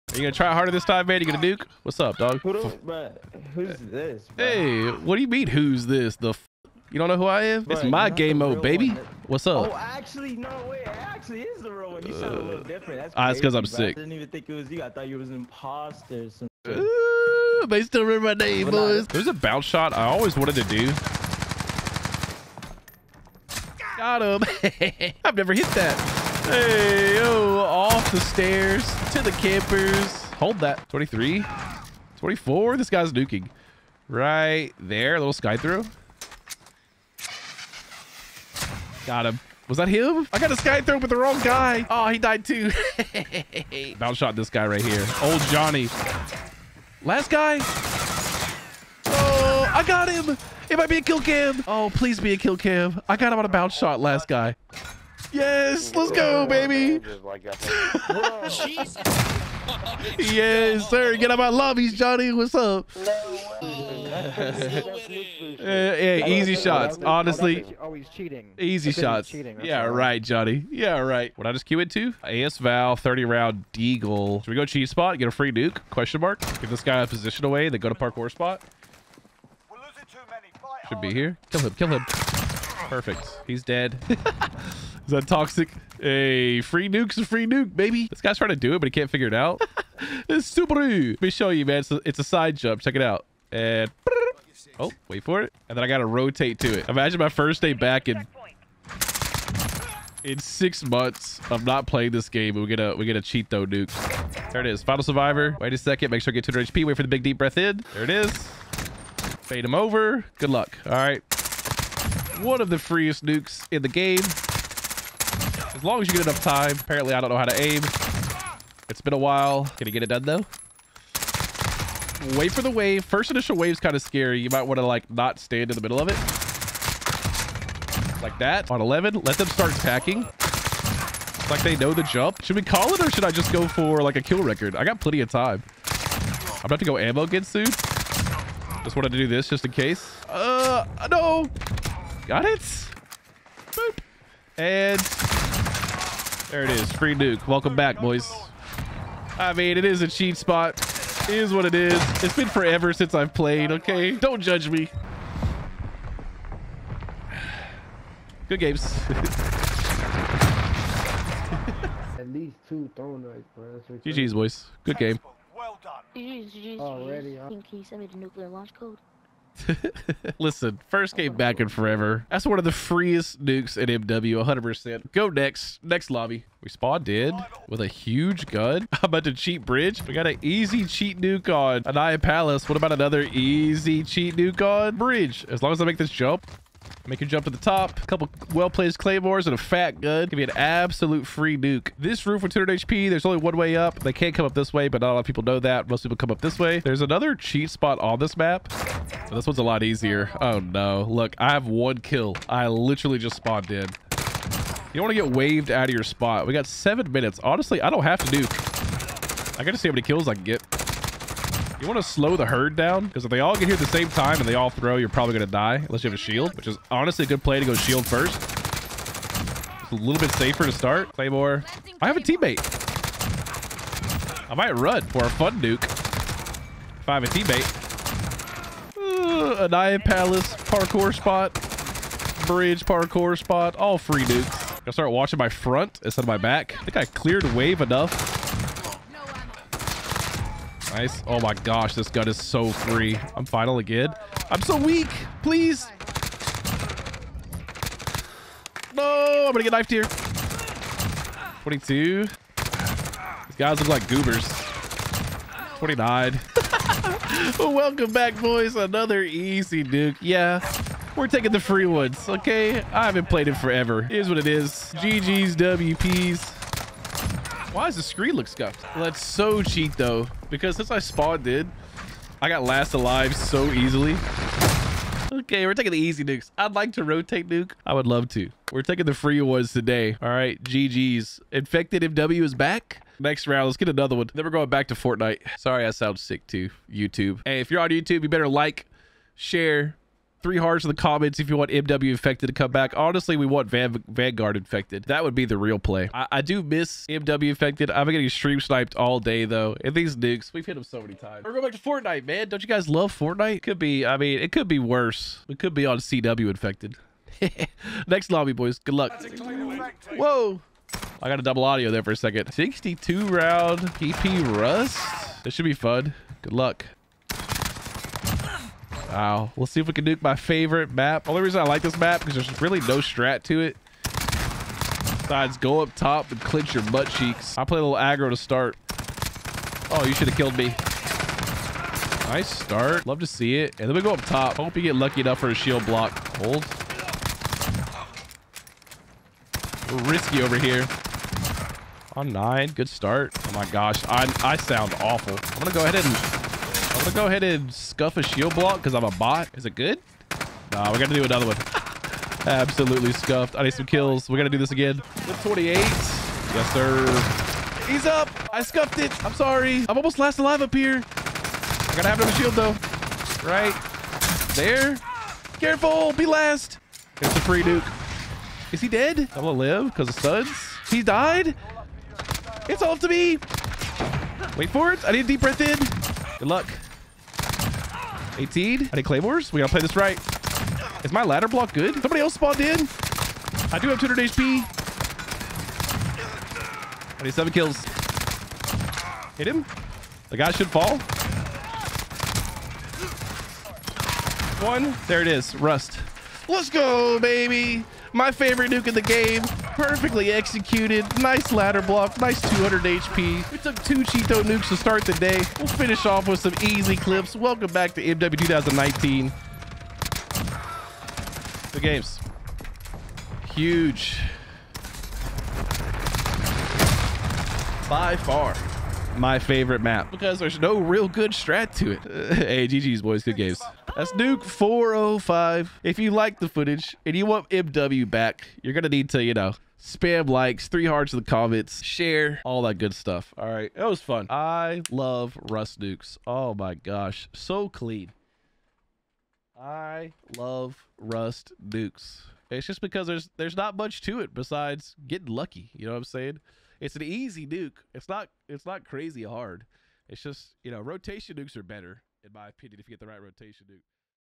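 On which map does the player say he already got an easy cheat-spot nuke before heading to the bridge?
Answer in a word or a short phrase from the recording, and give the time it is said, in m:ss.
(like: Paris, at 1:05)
Aniyah Palace, at 3:01.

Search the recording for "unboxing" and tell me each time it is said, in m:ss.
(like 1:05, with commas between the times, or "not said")
not said.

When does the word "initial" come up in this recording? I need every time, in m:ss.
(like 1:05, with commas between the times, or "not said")
2:03.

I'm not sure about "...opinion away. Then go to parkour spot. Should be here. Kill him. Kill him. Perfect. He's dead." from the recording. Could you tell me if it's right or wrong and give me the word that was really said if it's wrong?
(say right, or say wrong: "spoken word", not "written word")
wrong: "position", not "opinion".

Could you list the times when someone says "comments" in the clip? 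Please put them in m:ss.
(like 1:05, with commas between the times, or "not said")
4:50, 7:11.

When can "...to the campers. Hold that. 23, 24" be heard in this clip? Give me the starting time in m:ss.
0:29.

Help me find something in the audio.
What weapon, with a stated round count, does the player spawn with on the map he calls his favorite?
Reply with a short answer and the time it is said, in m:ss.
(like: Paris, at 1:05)
PP, at 5:13.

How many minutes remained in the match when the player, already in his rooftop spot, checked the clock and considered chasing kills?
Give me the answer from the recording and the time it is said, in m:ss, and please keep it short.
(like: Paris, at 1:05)
7, at 3:26.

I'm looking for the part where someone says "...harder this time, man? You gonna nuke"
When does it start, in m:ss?
0:00.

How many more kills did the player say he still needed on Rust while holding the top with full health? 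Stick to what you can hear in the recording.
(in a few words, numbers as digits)
7.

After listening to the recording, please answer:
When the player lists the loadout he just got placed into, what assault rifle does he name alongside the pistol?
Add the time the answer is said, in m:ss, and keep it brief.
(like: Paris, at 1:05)
AS Val, at 1:12.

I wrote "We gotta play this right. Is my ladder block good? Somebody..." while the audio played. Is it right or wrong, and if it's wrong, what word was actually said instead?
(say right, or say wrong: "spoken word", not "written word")
right.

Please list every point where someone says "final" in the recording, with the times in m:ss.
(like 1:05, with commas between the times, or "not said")
1:44, 4:03.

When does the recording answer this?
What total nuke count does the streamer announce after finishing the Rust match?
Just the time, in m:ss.
7:04.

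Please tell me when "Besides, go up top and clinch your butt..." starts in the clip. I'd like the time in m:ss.
5:25.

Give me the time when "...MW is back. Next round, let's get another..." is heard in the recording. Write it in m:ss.
4:42.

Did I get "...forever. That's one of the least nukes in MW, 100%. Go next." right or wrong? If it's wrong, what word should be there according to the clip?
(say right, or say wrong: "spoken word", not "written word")
wrong: "freest", not "least".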